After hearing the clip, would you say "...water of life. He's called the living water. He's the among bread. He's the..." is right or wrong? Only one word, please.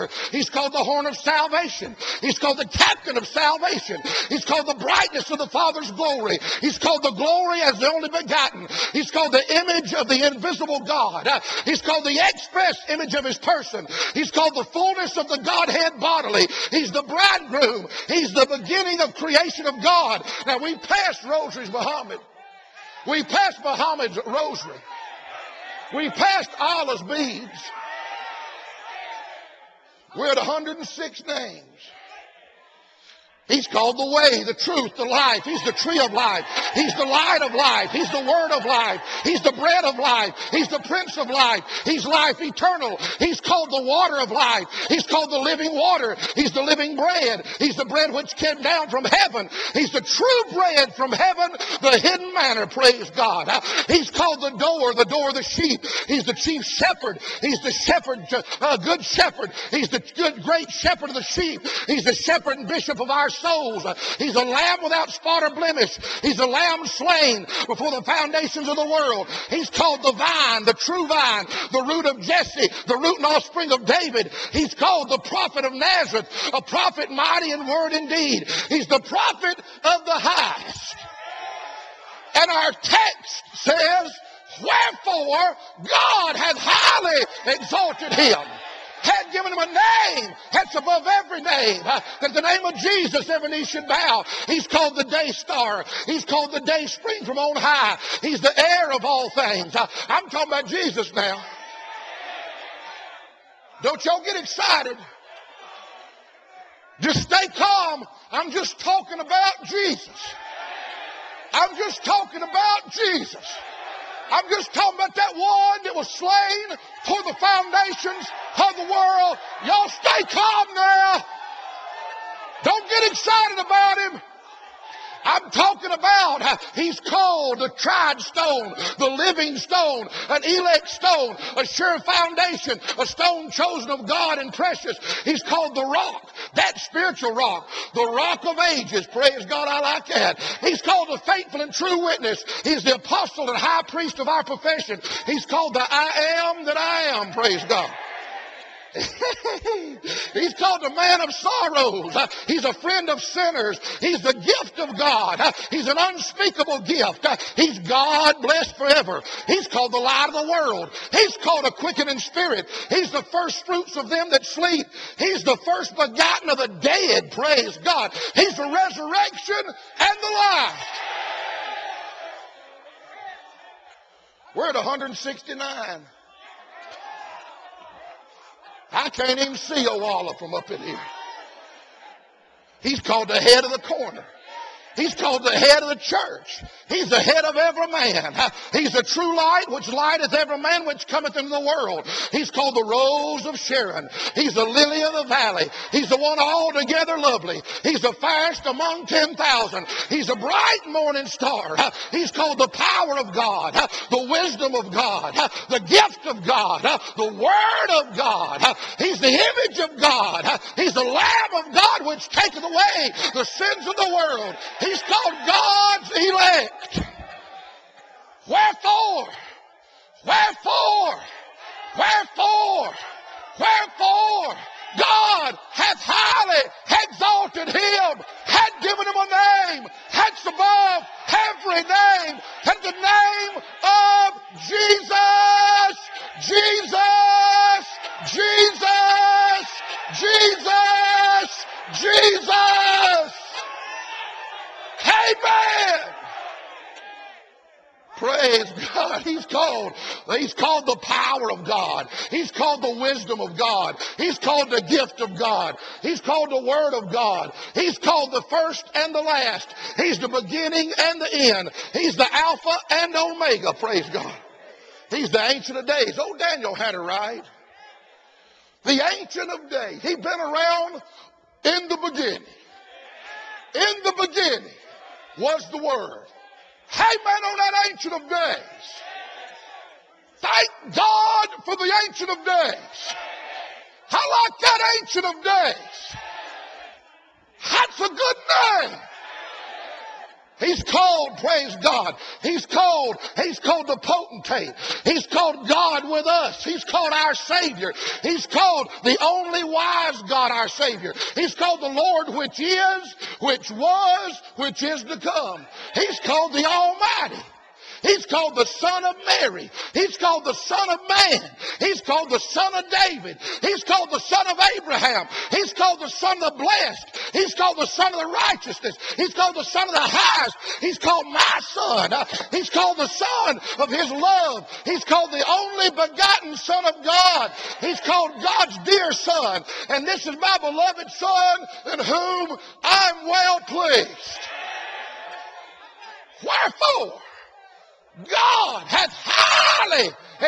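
wrong.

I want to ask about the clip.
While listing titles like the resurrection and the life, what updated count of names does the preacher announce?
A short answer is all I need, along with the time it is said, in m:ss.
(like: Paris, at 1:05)
169, at 2:54.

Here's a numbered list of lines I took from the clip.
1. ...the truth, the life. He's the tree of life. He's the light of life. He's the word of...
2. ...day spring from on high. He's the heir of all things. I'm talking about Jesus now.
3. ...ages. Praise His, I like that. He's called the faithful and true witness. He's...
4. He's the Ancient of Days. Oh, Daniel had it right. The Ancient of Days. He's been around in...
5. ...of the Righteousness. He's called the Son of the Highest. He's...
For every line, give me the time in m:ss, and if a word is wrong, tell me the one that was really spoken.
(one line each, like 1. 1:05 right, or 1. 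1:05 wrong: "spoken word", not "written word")
1. 0:34 right
2. 1:36 right
3. 2:18 wrong: "God", not "His"
4. 4:25 right
5. 5:18 right.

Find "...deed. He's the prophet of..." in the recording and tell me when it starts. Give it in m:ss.
1:18.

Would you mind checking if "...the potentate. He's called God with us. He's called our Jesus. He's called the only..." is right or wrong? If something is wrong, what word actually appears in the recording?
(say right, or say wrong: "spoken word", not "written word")
wrong: "Savior", not "Jesus".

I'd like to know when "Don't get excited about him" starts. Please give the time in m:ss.
2:02.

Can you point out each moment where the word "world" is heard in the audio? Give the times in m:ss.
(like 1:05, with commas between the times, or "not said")
1:08, 1:58, 2:40, 3:11, 3:34.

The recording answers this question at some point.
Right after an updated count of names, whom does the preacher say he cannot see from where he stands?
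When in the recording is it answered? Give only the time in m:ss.
2:59.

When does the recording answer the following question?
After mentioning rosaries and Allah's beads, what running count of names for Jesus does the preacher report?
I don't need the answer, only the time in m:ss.
0:30.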